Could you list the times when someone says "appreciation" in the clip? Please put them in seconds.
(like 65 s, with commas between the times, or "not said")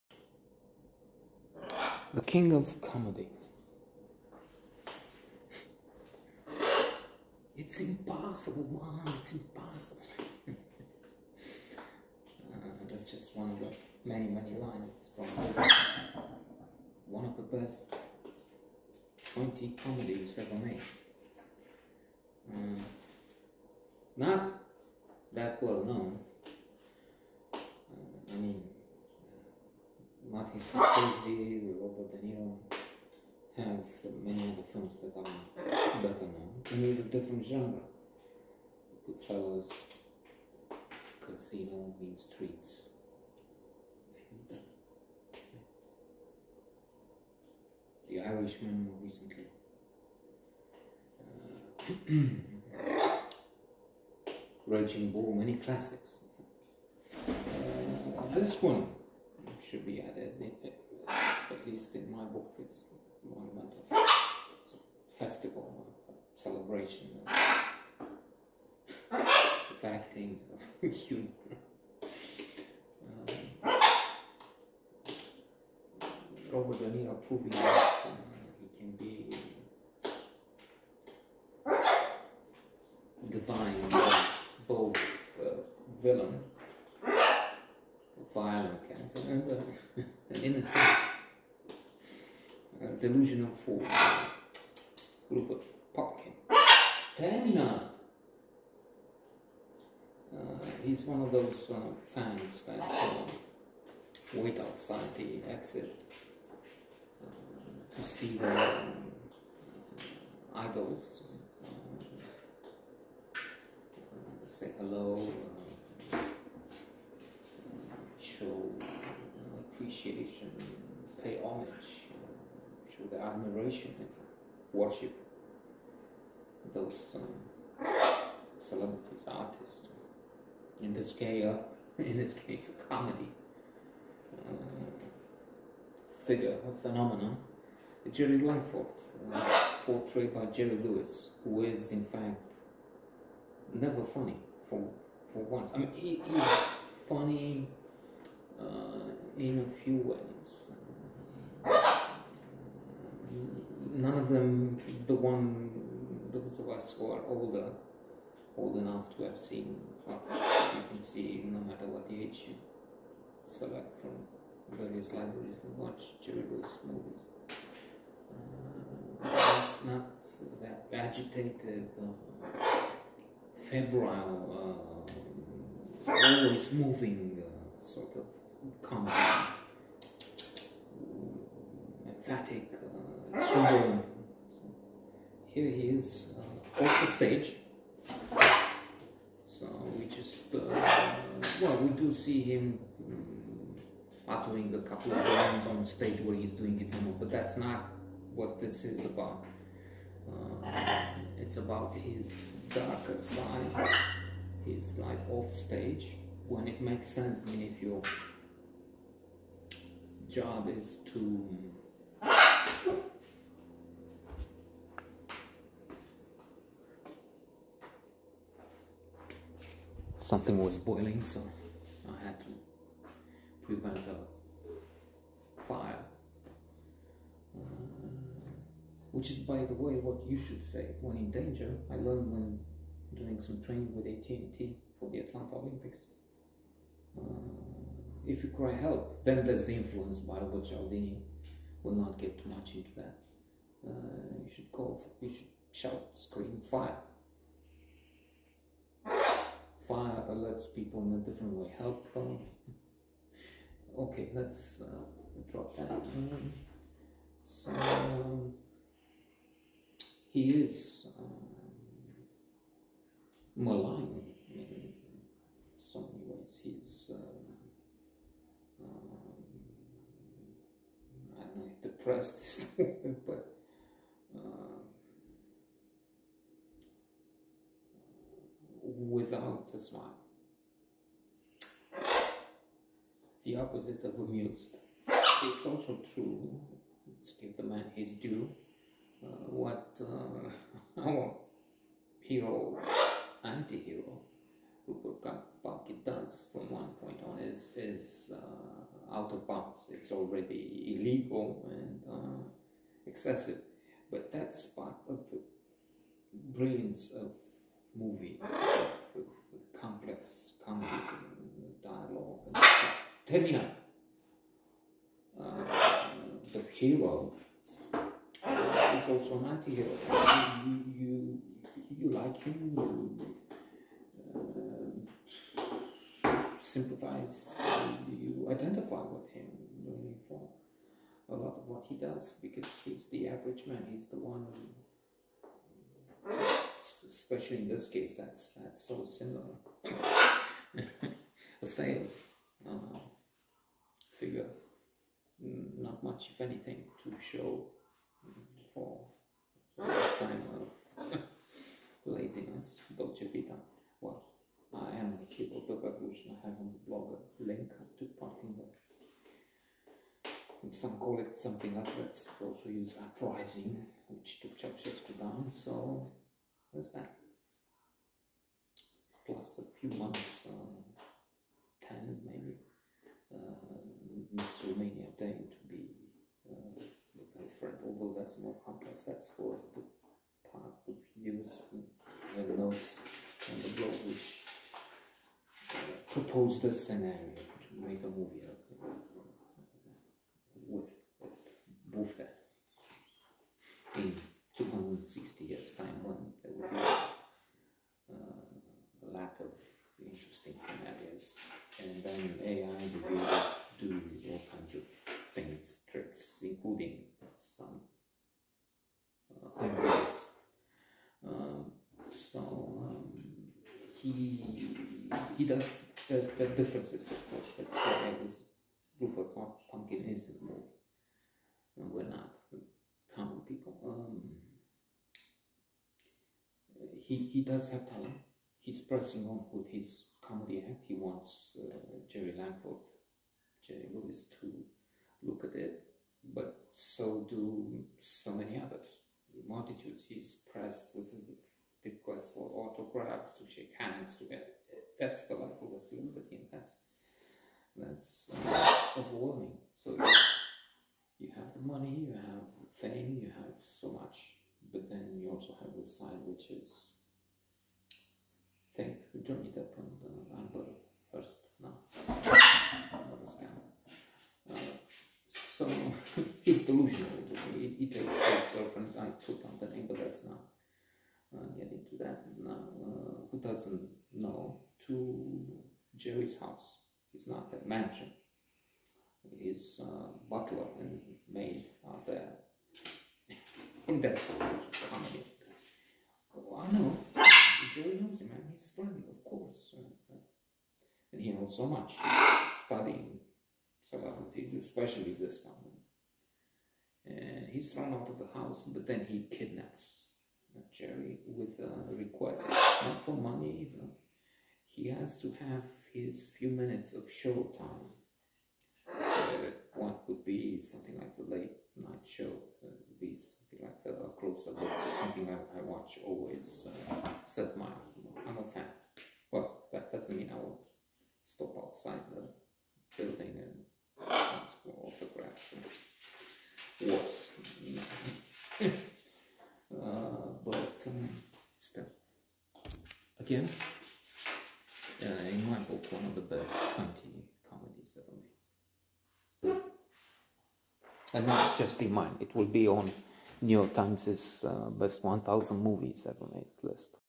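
119 s.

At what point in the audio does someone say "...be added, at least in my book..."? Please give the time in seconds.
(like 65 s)
59 s.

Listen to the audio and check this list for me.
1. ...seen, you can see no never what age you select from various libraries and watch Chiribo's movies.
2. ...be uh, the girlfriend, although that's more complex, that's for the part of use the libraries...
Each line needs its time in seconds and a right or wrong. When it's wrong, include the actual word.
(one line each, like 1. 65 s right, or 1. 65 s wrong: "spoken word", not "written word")
1. 159 s wrong: "matter", not "never"
2. 375 s wrong: "notes", not "libraries".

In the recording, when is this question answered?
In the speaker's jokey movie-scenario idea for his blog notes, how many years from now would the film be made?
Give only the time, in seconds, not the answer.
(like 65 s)
394 s.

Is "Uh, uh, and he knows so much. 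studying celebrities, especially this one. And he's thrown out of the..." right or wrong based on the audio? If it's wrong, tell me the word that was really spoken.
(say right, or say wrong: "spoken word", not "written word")
right.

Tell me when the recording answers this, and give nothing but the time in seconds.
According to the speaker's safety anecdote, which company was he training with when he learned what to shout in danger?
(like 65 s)
234 s.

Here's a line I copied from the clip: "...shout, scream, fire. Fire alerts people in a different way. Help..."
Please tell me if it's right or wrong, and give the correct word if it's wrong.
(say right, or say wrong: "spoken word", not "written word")
right.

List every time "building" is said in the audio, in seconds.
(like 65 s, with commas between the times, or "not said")
523 s.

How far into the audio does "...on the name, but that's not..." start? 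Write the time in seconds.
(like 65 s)
469 s.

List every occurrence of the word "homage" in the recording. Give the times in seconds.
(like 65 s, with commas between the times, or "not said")
121 s.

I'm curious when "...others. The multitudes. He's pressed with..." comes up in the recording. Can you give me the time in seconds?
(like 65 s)
438 s.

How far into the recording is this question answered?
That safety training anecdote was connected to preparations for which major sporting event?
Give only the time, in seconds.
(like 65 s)
235 s.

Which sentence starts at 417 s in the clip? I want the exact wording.
That's why I was Rupert Pupkin is in the movie.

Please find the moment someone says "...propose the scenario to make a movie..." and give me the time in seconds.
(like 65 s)
386 s.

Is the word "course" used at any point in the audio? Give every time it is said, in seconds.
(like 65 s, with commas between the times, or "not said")
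417 s, 489 s.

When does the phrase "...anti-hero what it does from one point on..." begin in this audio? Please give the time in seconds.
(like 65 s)
293 s.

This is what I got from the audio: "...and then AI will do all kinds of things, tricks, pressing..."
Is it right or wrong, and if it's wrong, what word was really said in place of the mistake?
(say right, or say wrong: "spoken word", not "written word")
wrong: "including", not "pressing".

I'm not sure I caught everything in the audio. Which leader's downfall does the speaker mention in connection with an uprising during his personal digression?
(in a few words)
Ceausescu.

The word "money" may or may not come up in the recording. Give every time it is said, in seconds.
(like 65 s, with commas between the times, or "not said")
451 s, 503 s.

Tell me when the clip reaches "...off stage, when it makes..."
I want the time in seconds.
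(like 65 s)
205 s.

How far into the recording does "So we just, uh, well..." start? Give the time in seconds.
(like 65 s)
189 s.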